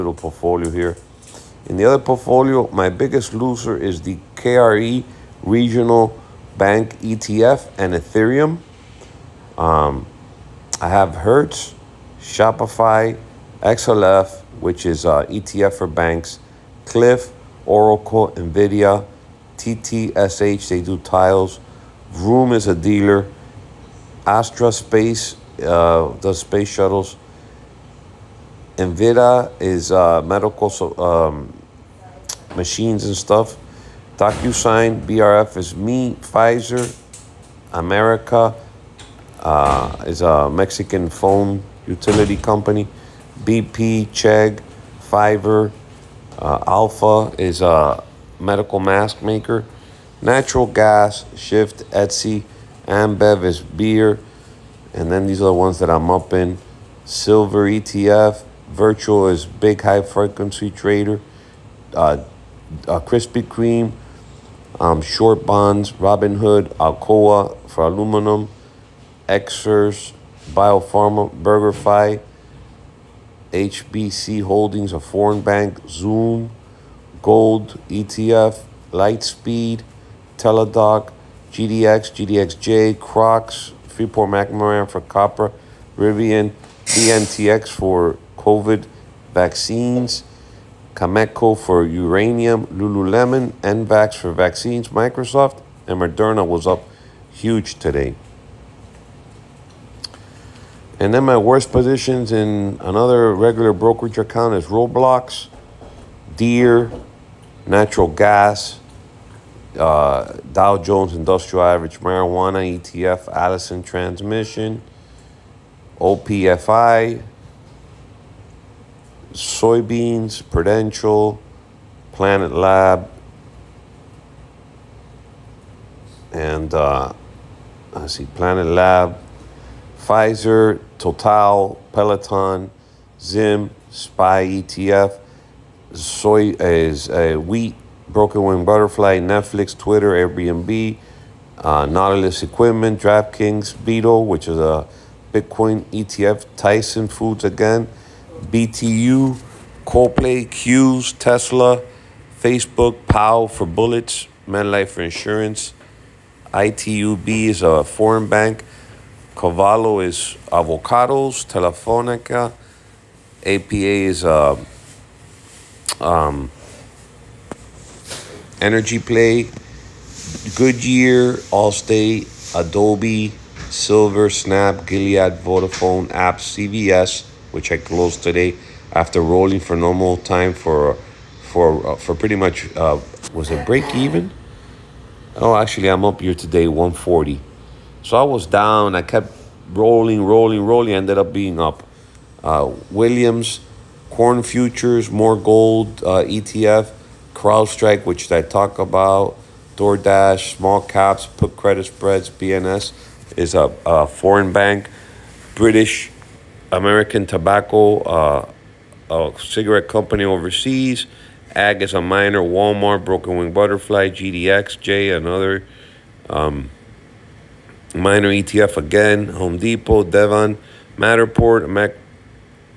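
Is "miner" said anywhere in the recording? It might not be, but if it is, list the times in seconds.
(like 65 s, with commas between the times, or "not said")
212 s, 217 s.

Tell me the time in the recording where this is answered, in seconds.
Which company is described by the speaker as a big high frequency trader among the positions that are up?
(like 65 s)
58 s.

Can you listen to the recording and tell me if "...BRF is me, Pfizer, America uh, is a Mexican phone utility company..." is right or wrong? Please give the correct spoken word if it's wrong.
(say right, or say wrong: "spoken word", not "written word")
right.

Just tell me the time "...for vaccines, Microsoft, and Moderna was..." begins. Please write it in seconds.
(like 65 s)
94 s.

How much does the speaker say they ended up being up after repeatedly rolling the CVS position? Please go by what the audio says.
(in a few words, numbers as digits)
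140.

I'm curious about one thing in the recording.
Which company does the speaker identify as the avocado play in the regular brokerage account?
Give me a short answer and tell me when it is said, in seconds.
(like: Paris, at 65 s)
Calavo, at 159 s.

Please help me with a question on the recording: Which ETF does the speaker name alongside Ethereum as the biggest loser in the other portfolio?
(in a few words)
KRE Regional Bank ETF.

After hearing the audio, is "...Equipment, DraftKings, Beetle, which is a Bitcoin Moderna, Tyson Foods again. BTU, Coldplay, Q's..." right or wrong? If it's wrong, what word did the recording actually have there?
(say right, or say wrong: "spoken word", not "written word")
wrong: "ETF", not "Moderna".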